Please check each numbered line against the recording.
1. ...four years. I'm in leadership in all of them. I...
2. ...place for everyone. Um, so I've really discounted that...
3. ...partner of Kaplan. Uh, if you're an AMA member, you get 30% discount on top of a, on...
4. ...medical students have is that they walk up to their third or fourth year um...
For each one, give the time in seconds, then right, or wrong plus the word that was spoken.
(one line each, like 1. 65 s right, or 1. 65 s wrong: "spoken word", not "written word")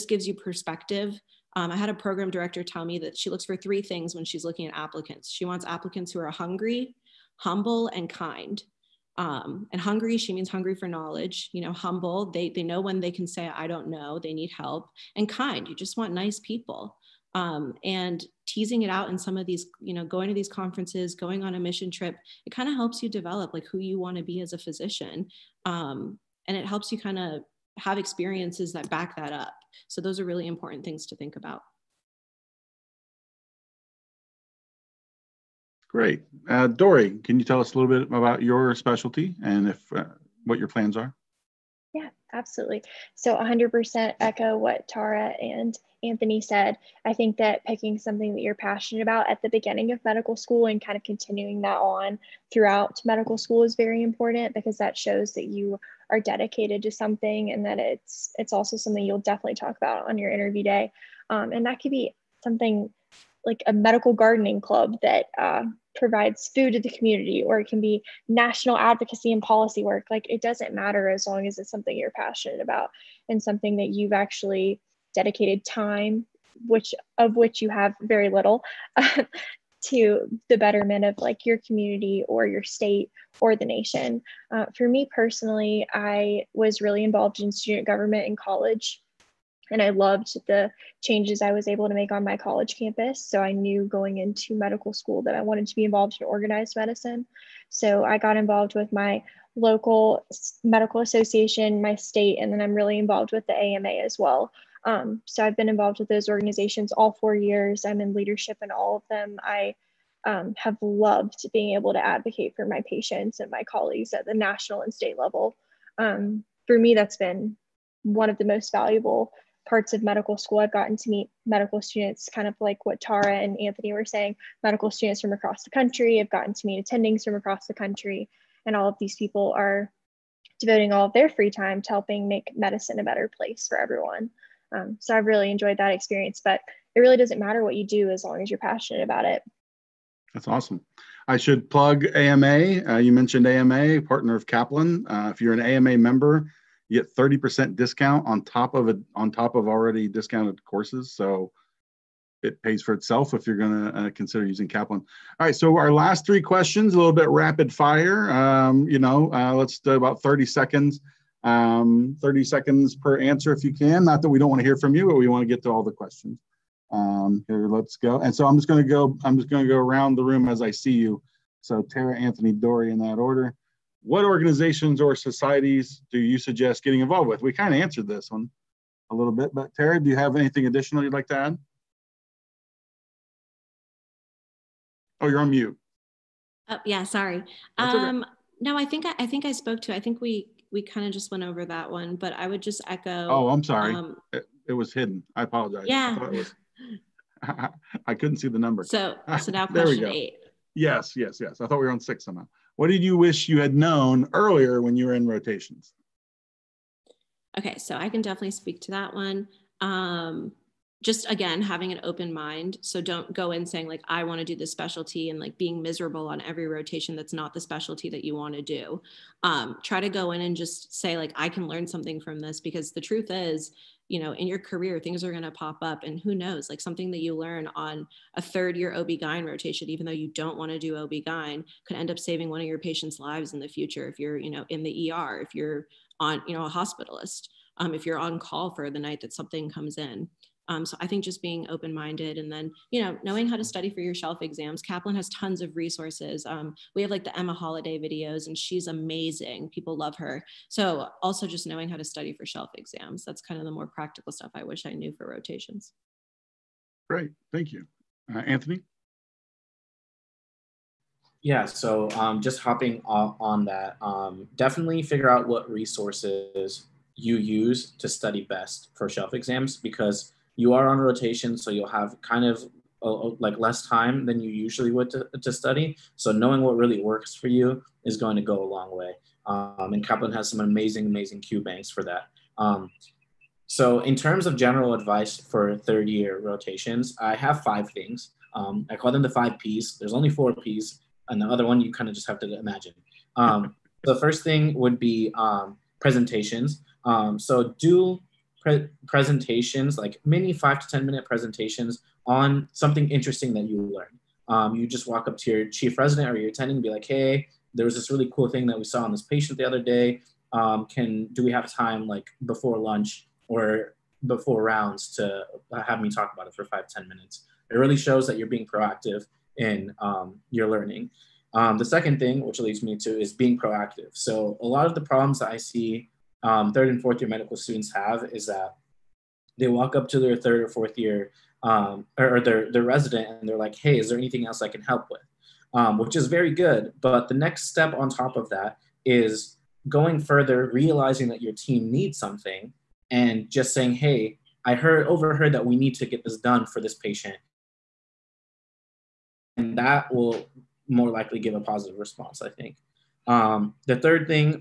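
1. 107 s right
2. 133 s wrong: "enjoyed", not "discounted"
3. 144 s right
4. 327 s right.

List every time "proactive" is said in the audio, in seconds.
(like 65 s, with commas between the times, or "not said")
318 s, 323 s.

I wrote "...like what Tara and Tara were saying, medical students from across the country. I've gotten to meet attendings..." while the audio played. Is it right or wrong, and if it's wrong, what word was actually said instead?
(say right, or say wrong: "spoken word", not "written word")
wrong: "Anthony", not "Tara".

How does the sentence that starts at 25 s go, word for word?
Um, and it helps you kind of have experiences that back that up.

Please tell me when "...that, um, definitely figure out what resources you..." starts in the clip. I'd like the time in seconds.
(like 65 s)
263 s.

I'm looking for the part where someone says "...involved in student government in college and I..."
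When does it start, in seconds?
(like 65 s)
87 s.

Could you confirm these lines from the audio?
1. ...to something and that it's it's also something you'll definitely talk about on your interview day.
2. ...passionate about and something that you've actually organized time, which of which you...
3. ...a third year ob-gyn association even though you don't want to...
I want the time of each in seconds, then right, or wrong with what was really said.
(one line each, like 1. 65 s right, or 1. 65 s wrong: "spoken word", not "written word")
1. 56 s right
2. 72 s wrong: "dedicated", not "organized"
3. 228 s wrong: "rotation", not "association".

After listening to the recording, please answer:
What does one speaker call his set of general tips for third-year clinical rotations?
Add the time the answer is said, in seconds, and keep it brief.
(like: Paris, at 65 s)
the five P's, at 289 s.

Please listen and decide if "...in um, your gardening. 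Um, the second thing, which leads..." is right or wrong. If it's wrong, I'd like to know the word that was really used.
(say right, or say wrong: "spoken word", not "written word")
wrong: "learning", not "gardening".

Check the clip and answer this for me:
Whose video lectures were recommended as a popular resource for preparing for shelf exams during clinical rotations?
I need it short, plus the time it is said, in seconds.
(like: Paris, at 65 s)
Emma Holliday, at 247 s.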